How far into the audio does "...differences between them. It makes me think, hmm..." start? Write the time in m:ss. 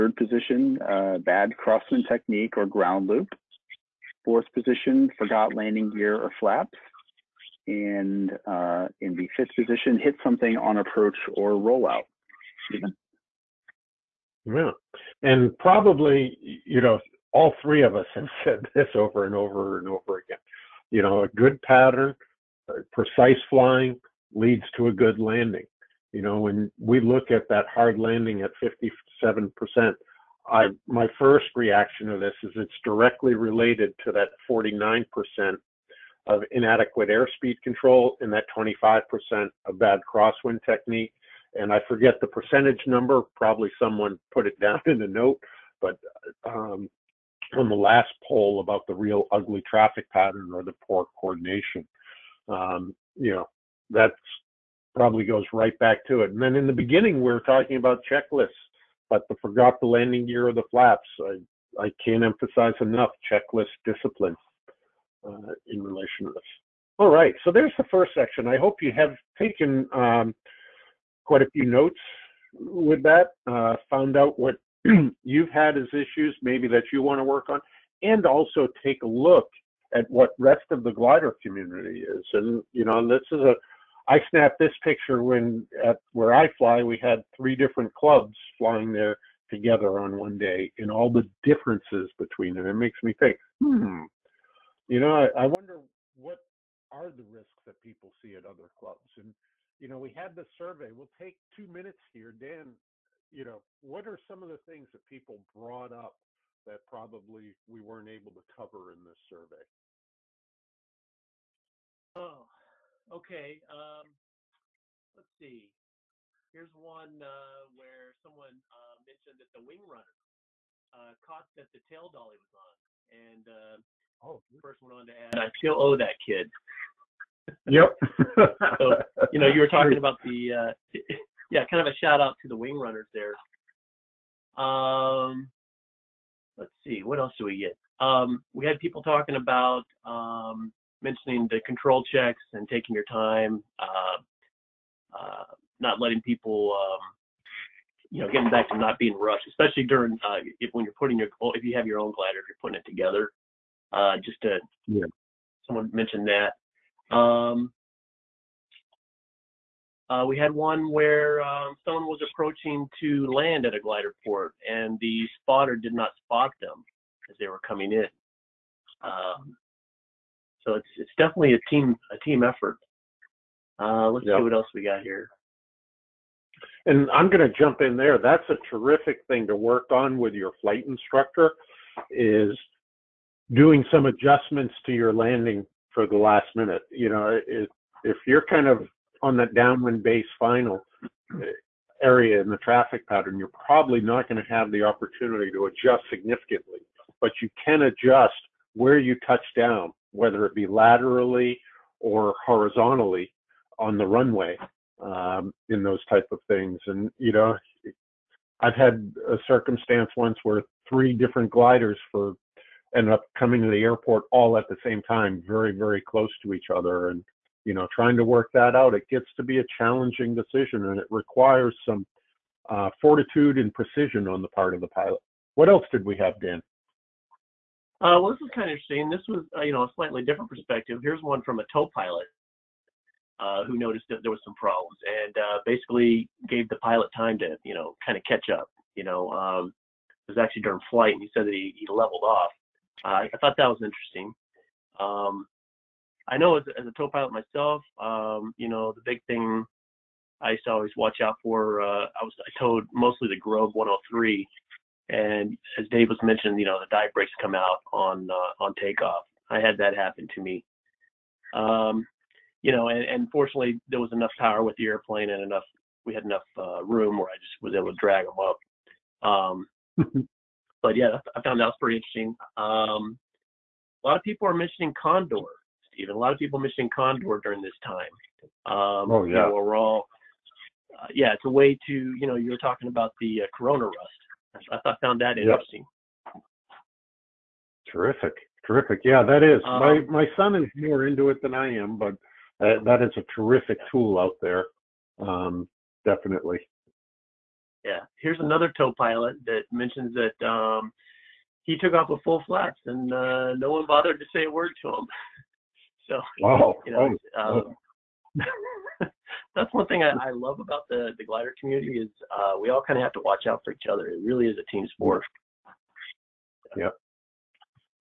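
1:31.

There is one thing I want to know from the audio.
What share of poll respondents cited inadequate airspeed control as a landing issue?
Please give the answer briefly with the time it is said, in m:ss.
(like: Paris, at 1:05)
49%, at 0:34.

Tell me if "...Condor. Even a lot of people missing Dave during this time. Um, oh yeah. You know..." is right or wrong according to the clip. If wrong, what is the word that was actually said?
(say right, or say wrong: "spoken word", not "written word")
wrong: "Condor", not "Dave".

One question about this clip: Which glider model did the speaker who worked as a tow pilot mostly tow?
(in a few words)
Grob 103.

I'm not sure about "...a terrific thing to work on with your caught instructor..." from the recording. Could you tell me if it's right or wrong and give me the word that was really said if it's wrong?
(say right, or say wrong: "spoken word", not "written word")
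wrong: "flight", not "caught".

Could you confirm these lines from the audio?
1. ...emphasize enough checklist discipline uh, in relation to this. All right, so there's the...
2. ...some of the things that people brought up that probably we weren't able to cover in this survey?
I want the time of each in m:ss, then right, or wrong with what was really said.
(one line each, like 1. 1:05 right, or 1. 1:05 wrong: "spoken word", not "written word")
1. 1:02 right
2. 1:44 right.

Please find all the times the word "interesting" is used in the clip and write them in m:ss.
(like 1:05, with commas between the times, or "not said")
3:48, 4:03, 4:31, 4:45.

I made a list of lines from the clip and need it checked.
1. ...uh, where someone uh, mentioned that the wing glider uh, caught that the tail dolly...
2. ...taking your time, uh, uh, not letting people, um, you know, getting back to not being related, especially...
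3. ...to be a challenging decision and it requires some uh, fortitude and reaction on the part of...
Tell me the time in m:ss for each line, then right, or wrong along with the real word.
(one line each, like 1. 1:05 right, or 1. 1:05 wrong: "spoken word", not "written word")
1. 1:57 wrong: "runner", not "glider"
2. 2:22 wrong: "rushed", not "related"
3. 3:39 wrong: "precision", not "reaction".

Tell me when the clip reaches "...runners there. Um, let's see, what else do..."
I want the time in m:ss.
2:12.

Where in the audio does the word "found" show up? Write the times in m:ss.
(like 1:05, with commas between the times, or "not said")
1:13, 4:31, 4:45.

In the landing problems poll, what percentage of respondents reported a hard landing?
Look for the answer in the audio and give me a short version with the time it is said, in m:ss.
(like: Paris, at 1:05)
57%, at 0:28.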